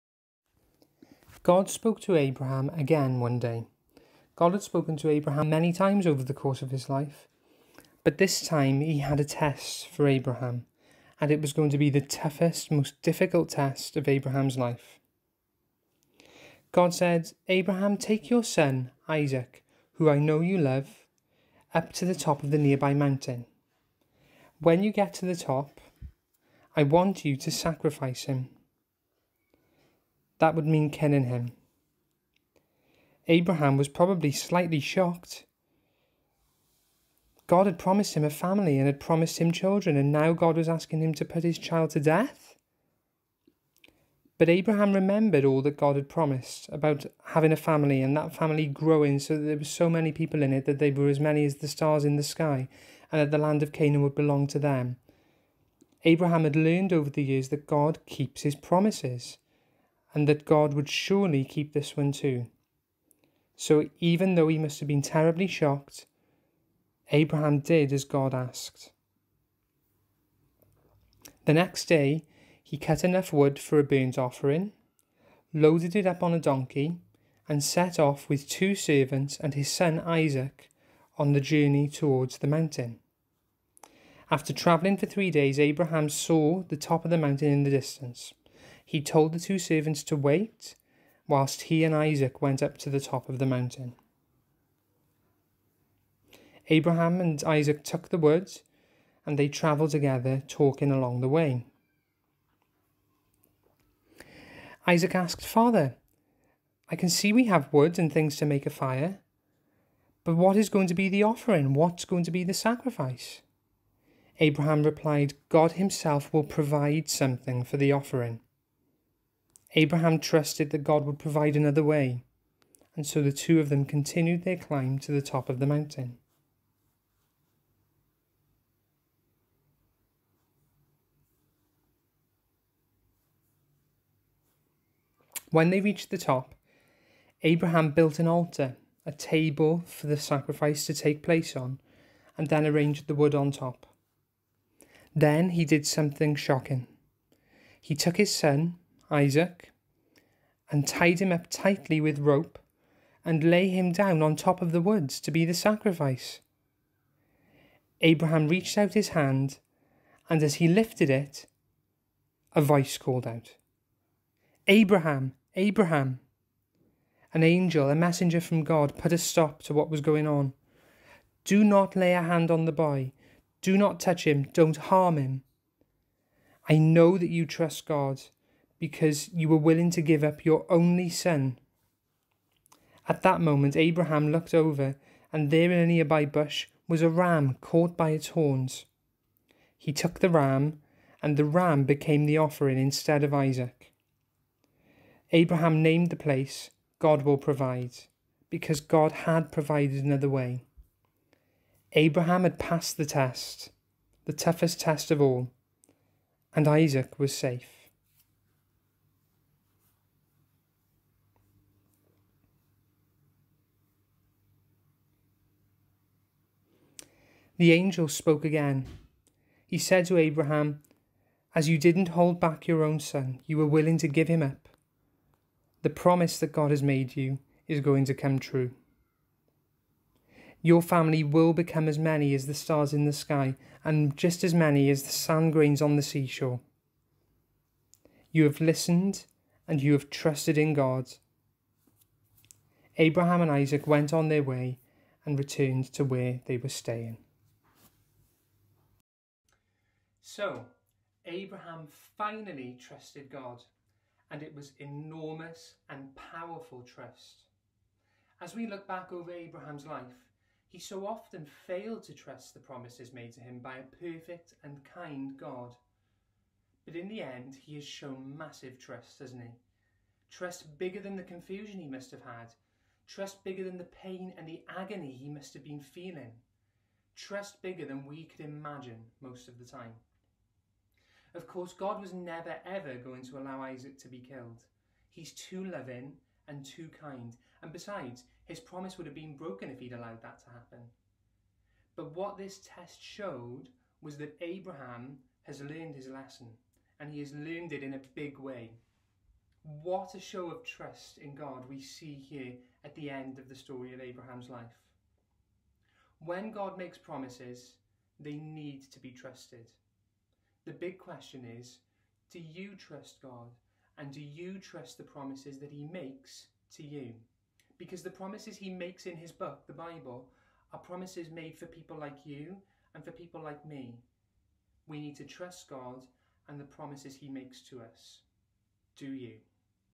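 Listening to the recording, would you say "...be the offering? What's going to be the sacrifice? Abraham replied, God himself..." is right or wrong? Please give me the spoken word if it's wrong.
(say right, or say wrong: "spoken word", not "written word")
right.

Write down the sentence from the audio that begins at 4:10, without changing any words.
So, Abraham finally trusted God, and it was enormous and powerful trust.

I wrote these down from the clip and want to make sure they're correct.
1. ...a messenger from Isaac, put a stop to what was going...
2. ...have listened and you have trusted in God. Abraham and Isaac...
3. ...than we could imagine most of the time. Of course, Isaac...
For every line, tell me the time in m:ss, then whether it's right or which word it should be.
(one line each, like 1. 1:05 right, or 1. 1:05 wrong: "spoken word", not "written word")
1. 2:47 wrong: "God", not "Isaac"
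2. 3:58 right
3. 4:37 wrong: "God", not "Isaac".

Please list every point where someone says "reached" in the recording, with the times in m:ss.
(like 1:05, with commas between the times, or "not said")
2:15, 2:38.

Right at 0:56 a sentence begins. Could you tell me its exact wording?
Abraham had learned over the years that God keeps his promises and that God would surely keep this one too.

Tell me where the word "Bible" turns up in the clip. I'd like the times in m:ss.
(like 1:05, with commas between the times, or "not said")
5:19.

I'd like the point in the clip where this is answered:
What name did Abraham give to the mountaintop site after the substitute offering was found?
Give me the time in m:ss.
3:16.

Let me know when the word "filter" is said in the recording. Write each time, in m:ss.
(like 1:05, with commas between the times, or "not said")
not said.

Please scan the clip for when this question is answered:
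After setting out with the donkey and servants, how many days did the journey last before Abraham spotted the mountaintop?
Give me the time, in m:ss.
1:25.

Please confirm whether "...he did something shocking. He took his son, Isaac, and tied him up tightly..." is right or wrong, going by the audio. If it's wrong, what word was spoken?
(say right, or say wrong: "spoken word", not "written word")
right.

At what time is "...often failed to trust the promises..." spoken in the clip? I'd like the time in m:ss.
4:21.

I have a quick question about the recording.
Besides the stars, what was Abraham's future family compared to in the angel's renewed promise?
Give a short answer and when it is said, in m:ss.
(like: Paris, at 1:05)
Sand grains on the seashore, at 3:55.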